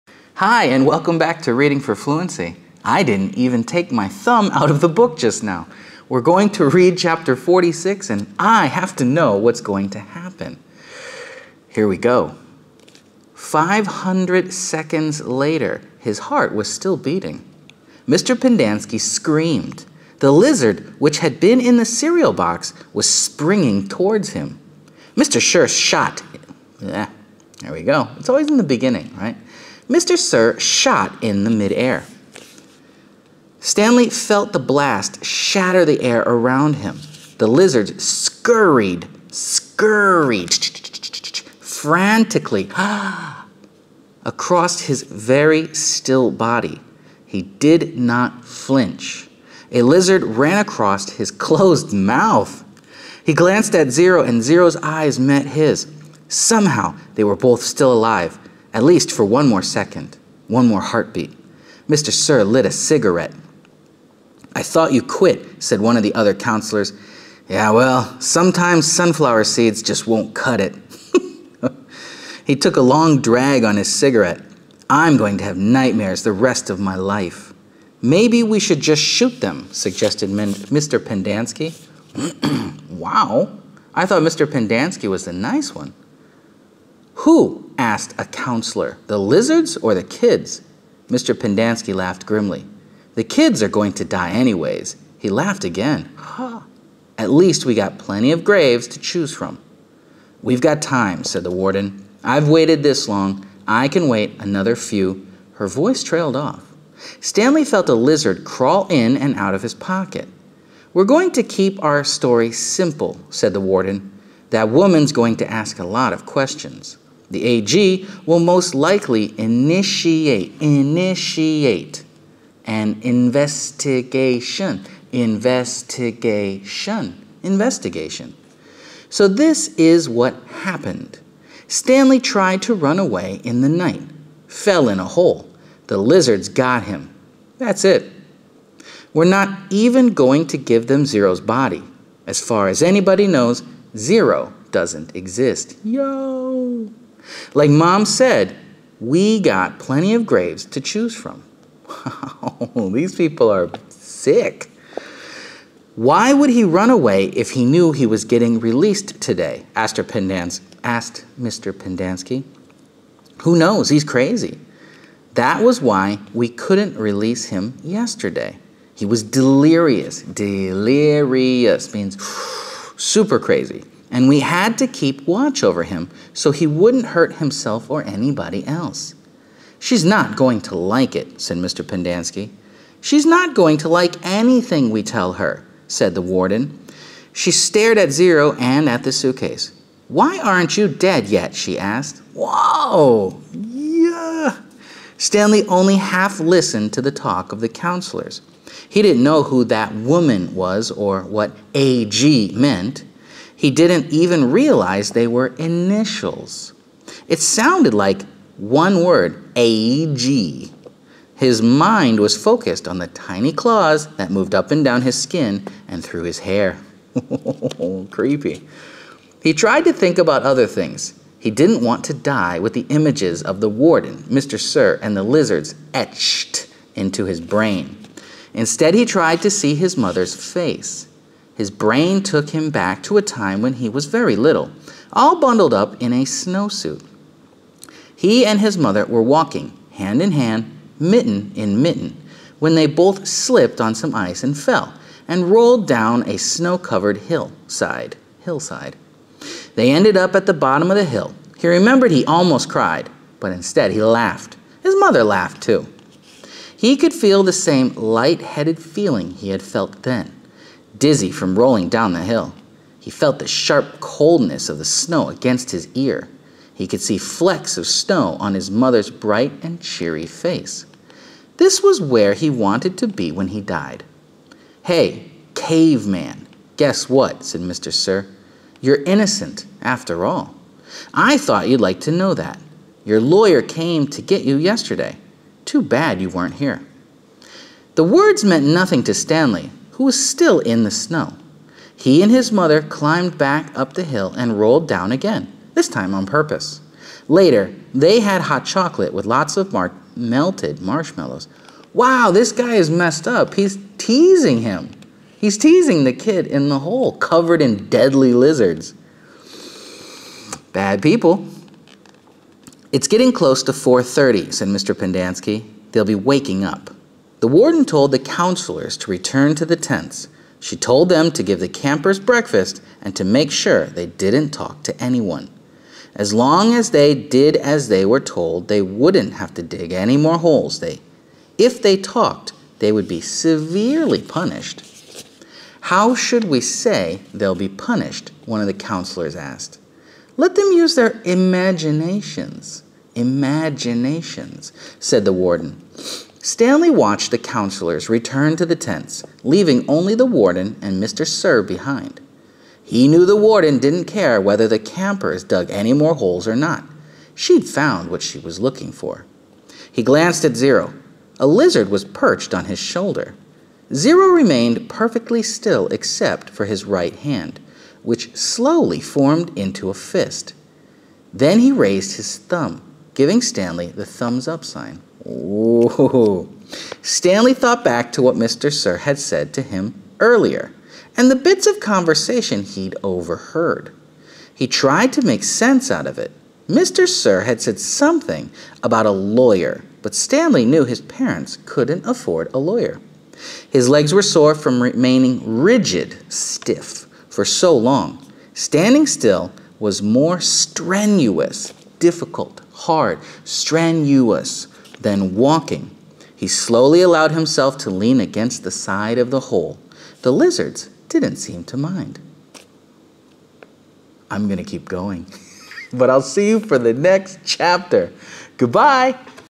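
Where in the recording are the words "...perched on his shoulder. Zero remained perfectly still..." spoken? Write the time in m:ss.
6:02.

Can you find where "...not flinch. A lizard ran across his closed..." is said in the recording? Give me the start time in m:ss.
0:47.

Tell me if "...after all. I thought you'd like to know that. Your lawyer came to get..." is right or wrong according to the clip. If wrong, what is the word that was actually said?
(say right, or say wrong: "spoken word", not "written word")
right.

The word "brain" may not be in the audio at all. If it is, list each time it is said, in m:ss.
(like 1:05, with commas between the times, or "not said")
3:47, 3:51.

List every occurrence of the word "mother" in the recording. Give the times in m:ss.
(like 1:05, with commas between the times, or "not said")
3:49, 3:58, 4:14, 4:28, 4:52.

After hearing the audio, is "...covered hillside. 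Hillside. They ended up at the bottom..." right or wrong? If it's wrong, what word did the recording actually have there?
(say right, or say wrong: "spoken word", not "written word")
right.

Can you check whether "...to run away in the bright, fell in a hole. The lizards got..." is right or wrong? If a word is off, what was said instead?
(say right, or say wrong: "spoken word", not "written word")
wrong: "night", not "bright".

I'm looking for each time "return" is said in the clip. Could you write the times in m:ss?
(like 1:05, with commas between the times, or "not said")
5:19, 5:48.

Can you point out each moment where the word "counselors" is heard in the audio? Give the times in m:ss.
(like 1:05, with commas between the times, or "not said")
1:06, 1:28, 3:17, 5:18, 5:38, 5:47.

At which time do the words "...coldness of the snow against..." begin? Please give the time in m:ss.
4:23.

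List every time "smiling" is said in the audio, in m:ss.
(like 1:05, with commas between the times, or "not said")
not said.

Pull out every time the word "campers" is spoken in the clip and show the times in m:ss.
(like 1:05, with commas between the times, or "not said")
5:21, 5:54.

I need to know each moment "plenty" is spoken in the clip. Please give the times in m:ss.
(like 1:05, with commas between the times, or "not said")
1:37, 2:29.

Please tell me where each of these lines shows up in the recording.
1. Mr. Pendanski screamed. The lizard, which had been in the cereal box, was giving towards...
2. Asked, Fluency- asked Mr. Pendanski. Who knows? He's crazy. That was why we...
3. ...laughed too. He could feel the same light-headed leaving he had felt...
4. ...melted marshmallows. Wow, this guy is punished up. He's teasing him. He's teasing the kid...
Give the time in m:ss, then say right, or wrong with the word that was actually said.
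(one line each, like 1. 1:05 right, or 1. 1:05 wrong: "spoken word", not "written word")
1. 0:18 wrong: "springing", not "giving"
2. 2:39 wrong: "Pendans", not "Fluency"
3. 4:15 wrong: "feeling", not "leaving"
4. 5:00 wrong: "messed", not "punished".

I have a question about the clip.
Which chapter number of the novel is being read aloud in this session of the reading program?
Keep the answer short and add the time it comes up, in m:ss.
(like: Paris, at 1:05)
46, at 0:07.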